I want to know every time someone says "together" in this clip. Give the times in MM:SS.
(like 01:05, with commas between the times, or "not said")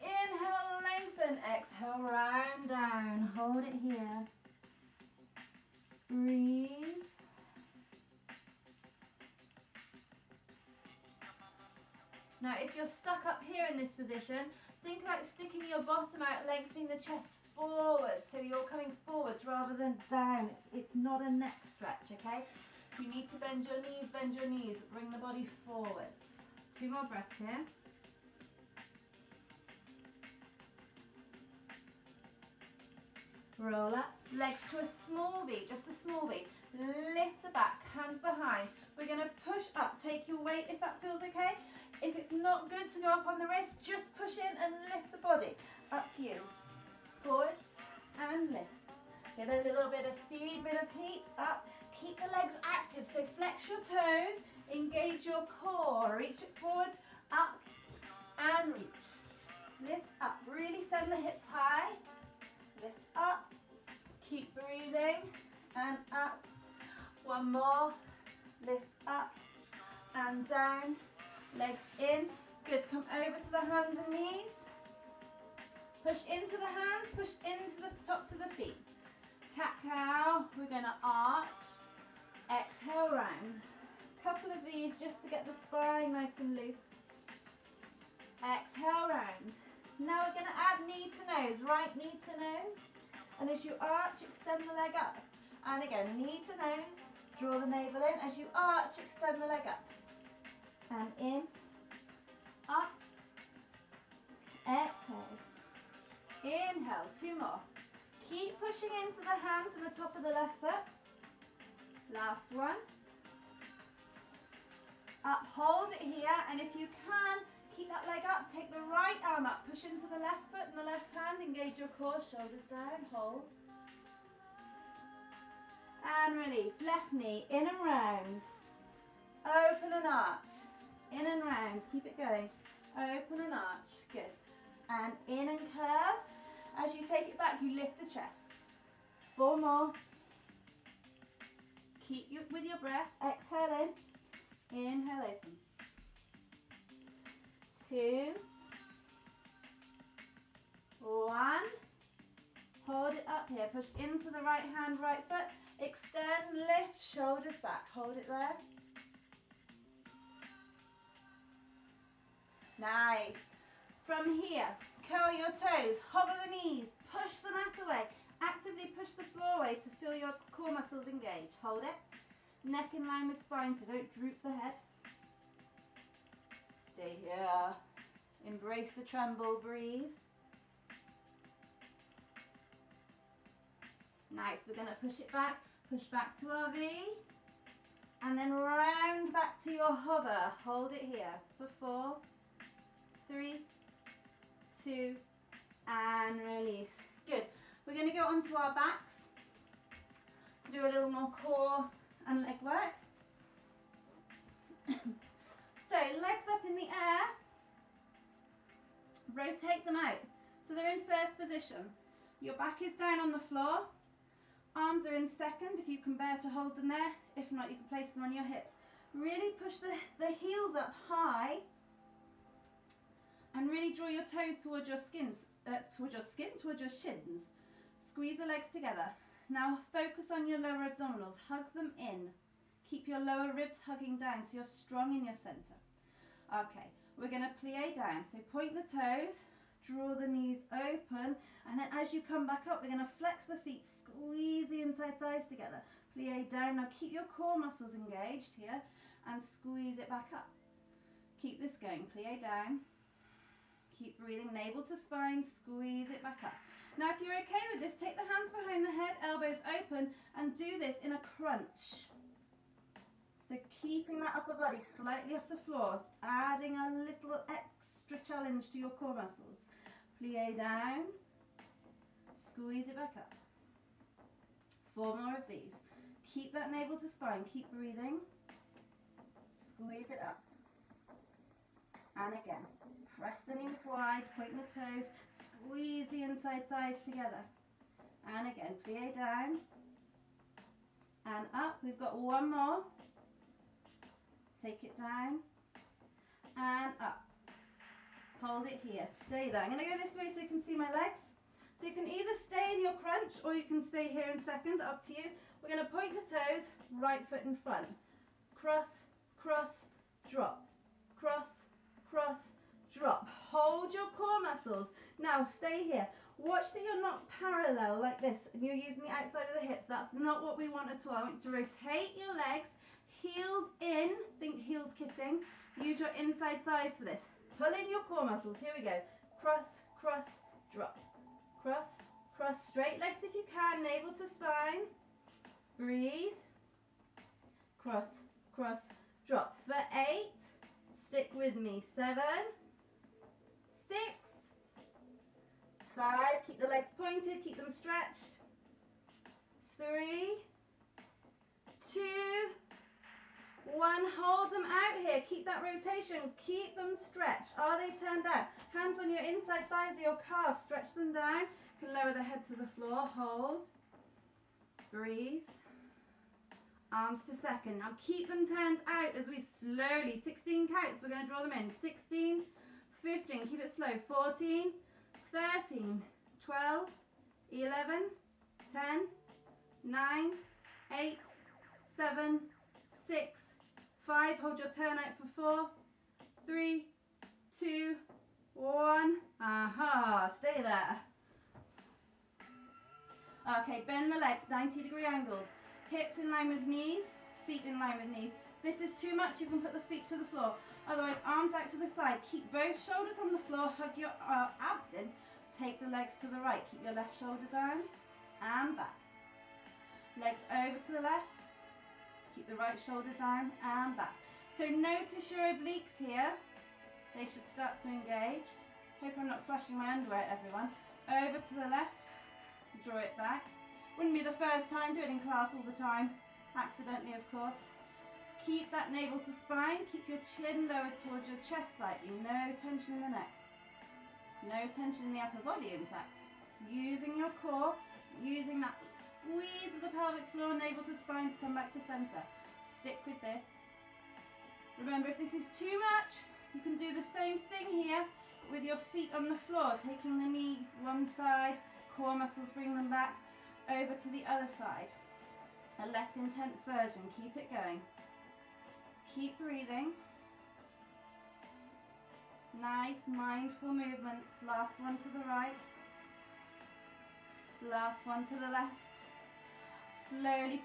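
03:48, 04:05, 04:47.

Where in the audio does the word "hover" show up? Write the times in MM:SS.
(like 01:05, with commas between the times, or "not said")
02:46, 03:09.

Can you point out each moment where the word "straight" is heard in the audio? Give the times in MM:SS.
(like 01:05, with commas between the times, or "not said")
05:32.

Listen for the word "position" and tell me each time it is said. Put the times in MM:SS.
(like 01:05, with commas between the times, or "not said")
00:13, 03:31.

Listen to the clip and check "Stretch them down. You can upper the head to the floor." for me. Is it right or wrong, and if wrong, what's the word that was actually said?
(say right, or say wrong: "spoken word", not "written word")
wrong: "lower", not "upper".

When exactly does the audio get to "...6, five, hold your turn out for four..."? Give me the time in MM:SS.
06:23.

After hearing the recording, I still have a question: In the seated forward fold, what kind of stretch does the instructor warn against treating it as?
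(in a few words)
Neck stretch.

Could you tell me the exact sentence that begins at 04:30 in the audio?
Plie down, squeeze it back up.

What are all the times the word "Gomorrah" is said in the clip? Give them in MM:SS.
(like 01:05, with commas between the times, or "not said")
not said.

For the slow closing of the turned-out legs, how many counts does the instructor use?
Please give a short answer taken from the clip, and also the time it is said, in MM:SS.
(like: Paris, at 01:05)
16, at 06:10.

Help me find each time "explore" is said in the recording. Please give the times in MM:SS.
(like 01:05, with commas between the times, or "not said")
07:20.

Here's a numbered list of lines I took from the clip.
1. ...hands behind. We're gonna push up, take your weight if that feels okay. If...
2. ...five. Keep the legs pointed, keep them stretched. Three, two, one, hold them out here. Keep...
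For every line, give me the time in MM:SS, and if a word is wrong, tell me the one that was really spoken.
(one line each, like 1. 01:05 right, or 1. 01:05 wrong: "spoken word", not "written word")
1. 00:37 right
2. 05:45 right.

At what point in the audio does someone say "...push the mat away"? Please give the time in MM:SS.
02:47.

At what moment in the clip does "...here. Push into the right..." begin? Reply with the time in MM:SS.
02:33.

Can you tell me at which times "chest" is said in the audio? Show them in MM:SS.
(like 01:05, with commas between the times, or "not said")
00:16, 02:18, 07:11.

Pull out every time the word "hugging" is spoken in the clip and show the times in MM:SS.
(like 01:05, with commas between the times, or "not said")
03:53.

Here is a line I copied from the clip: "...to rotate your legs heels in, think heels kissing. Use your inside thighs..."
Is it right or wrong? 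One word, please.
right.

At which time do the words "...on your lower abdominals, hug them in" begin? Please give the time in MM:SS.
03:50.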